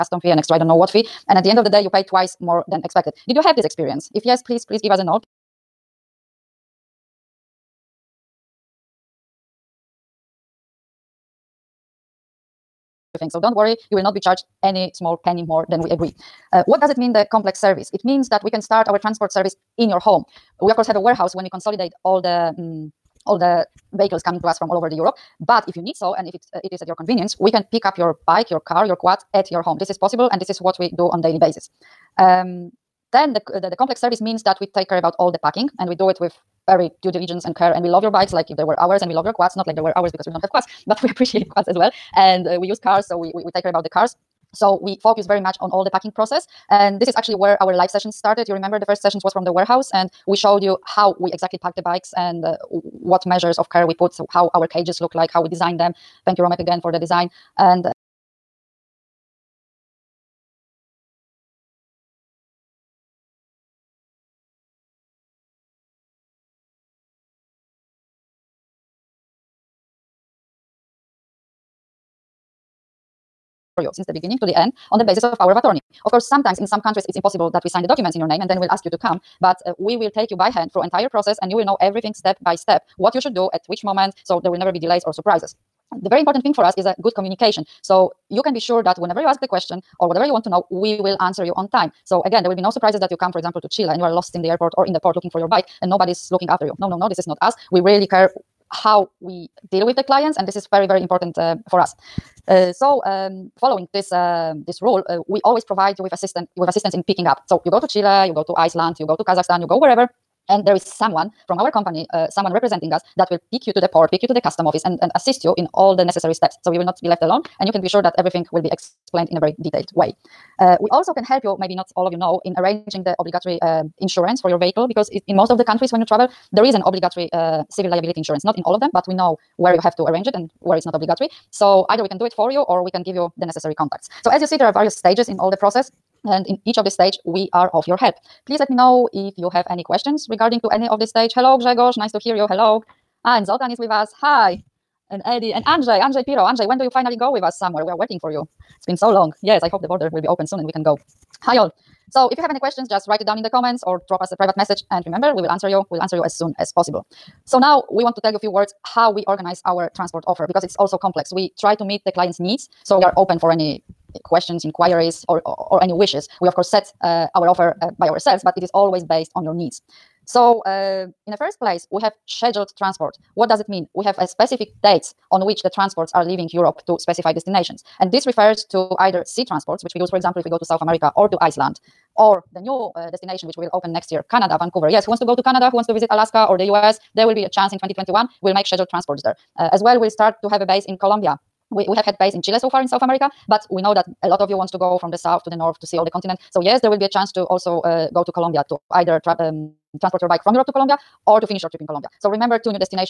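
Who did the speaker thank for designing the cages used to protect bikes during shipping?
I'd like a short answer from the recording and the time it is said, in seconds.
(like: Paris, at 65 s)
Romek, at 56 s.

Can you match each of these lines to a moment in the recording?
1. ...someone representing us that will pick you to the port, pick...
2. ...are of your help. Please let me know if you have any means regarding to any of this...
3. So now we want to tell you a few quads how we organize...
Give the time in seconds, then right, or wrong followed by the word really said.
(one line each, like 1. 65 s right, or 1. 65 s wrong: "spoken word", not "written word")
1. 112 s right
2. 137 s wrong: "questions", not "means"
3. 157 s wrong: "words", not "quads".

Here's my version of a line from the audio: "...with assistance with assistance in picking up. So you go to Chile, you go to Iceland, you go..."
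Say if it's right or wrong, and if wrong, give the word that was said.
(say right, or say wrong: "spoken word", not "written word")
right.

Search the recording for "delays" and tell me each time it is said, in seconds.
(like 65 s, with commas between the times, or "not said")
84 s.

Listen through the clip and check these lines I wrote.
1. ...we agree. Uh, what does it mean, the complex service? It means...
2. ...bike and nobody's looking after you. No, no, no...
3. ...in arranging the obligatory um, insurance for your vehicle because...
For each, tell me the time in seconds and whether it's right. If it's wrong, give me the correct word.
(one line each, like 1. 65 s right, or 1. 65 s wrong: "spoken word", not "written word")
1. 15 s right
2. 95 s right
3. 122 s right.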